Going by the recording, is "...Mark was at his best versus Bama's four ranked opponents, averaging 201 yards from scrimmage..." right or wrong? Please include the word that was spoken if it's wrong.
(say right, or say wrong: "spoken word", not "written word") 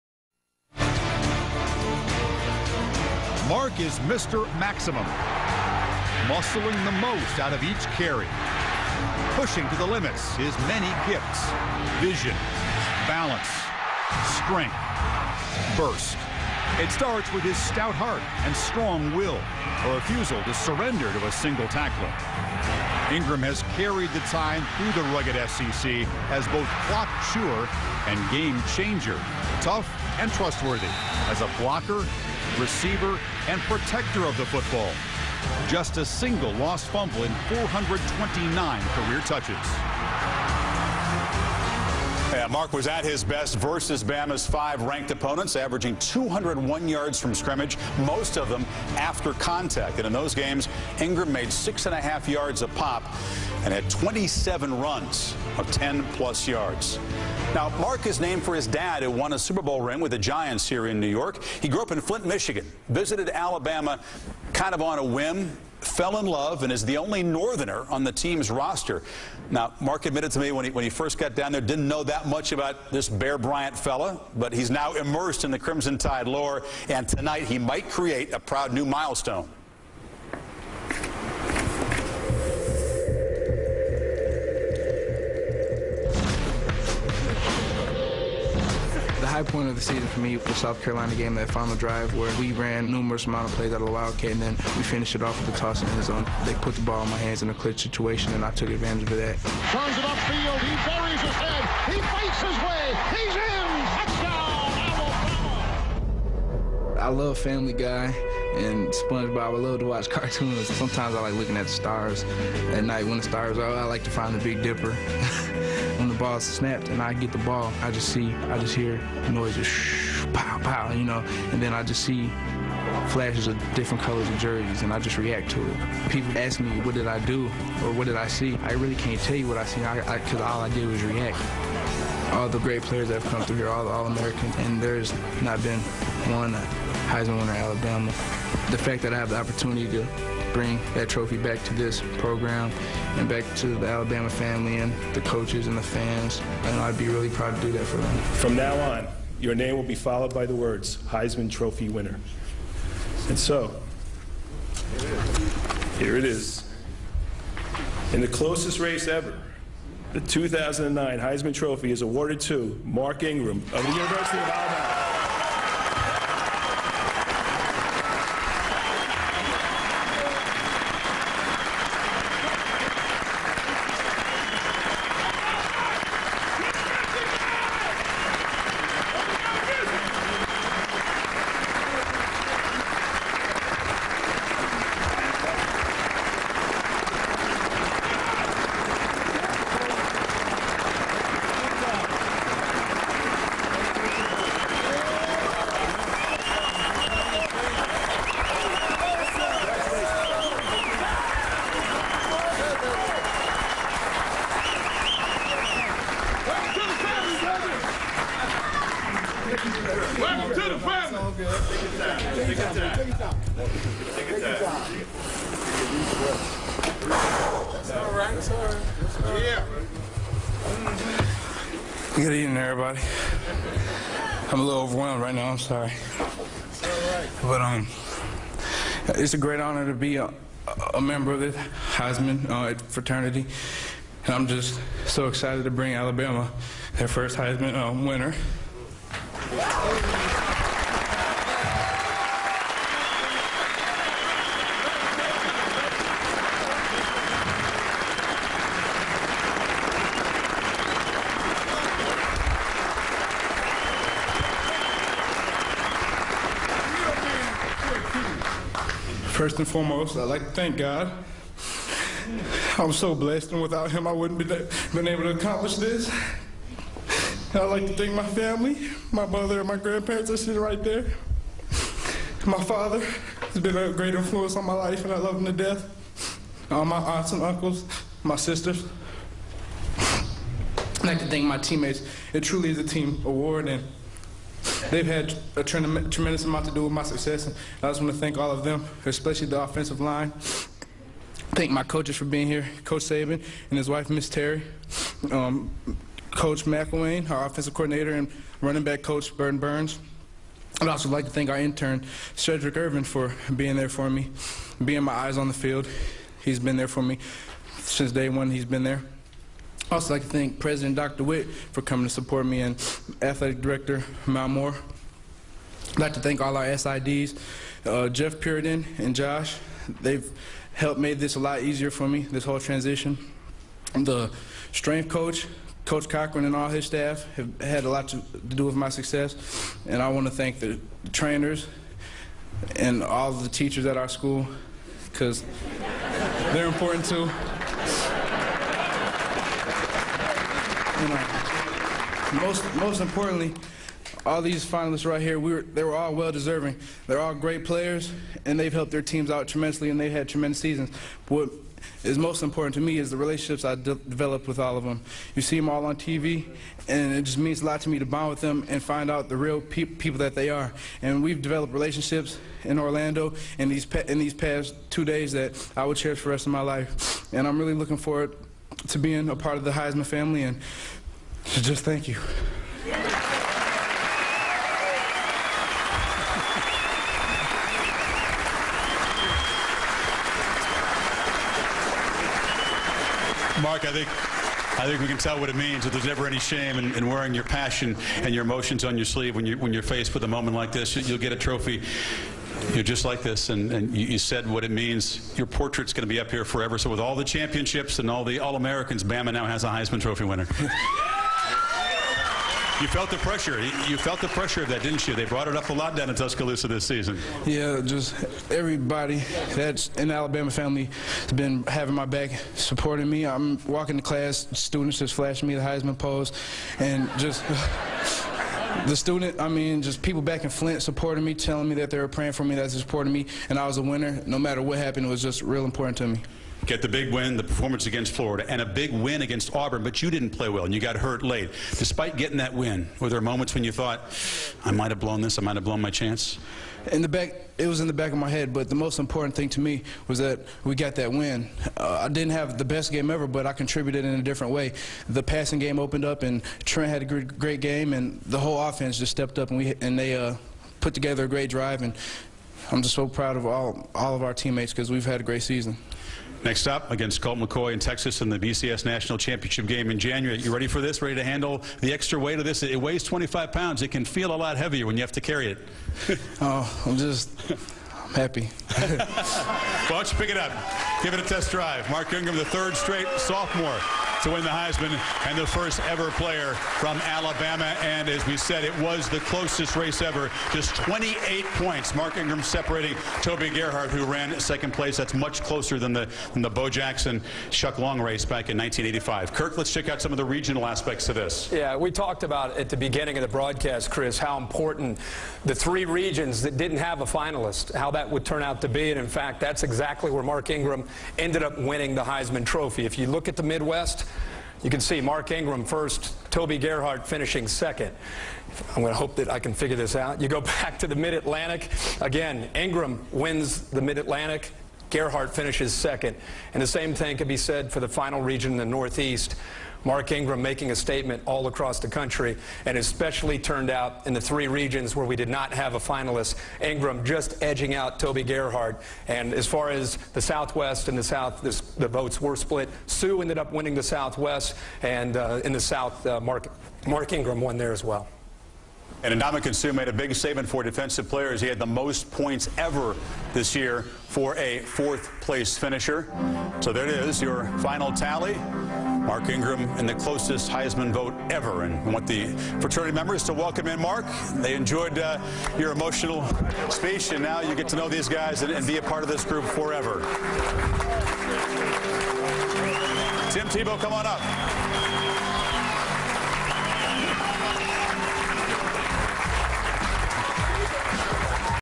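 wrong: "five", not "four".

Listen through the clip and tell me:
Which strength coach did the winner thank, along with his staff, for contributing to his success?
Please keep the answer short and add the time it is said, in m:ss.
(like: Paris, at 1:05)
Coach Cochran, at 5:25.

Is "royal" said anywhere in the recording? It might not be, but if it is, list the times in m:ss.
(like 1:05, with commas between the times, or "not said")
not said.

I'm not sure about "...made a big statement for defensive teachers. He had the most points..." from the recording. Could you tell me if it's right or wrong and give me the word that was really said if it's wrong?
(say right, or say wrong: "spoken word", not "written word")
wrong: "players", not "teachers".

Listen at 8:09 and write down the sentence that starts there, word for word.
Kirk, let's check out some of the regional aspects of this.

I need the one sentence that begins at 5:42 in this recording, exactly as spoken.
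most, most importantly, all these finalists right here, we were, they were all well deserving.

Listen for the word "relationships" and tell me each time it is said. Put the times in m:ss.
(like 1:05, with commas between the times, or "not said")
5:53, 6:01.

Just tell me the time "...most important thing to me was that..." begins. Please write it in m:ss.
7:18.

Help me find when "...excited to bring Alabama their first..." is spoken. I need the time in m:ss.
3:55.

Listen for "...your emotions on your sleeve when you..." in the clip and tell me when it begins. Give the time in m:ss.
6:28.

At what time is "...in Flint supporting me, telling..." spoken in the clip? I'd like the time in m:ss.
7:00.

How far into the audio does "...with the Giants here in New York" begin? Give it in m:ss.
0:59.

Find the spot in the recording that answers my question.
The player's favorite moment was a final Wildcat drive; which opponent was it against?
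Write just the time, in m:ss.
1:30.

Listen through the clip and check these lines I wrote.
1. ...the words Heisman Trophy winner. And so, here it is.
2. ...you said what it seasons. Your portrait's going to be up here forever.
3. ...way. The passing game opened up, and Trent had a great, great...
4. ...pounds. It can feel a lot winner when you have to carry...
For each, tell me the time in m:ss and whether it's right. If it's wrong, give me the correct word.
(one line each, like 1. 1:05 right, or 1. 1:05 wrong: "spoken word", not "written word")
1. 2:30 right
2. 6:34 wrong: "means", not "seasons"
3. 7:24 right
4. 7:43 wrong: "heavier", not "winner".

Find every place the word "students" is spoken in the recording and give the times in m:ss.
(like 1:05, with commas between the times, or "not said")
6:54, 6:58.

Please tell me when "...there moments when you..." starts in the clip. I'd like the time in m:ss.
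7:13.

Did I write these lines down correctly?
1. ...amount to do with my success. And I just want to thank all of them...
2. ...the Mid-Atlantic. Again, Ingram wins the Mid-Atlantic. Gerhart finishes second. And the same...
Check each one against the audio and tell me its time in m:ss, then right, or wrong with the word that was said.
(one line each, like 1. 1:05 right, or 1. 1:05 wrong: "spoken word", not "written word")
1. 4:46 right
2. 8:30 right.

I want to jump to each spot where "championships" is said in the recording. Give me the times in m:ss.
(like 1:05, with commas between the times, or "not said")
6:37, 7:39.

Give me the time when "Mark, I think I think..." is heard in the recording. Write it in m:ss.
6:23.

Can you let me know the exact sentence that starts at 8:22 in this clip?
If you look at the Midwest, you can see Mark Ingram first, Toby Gerhart finishing second.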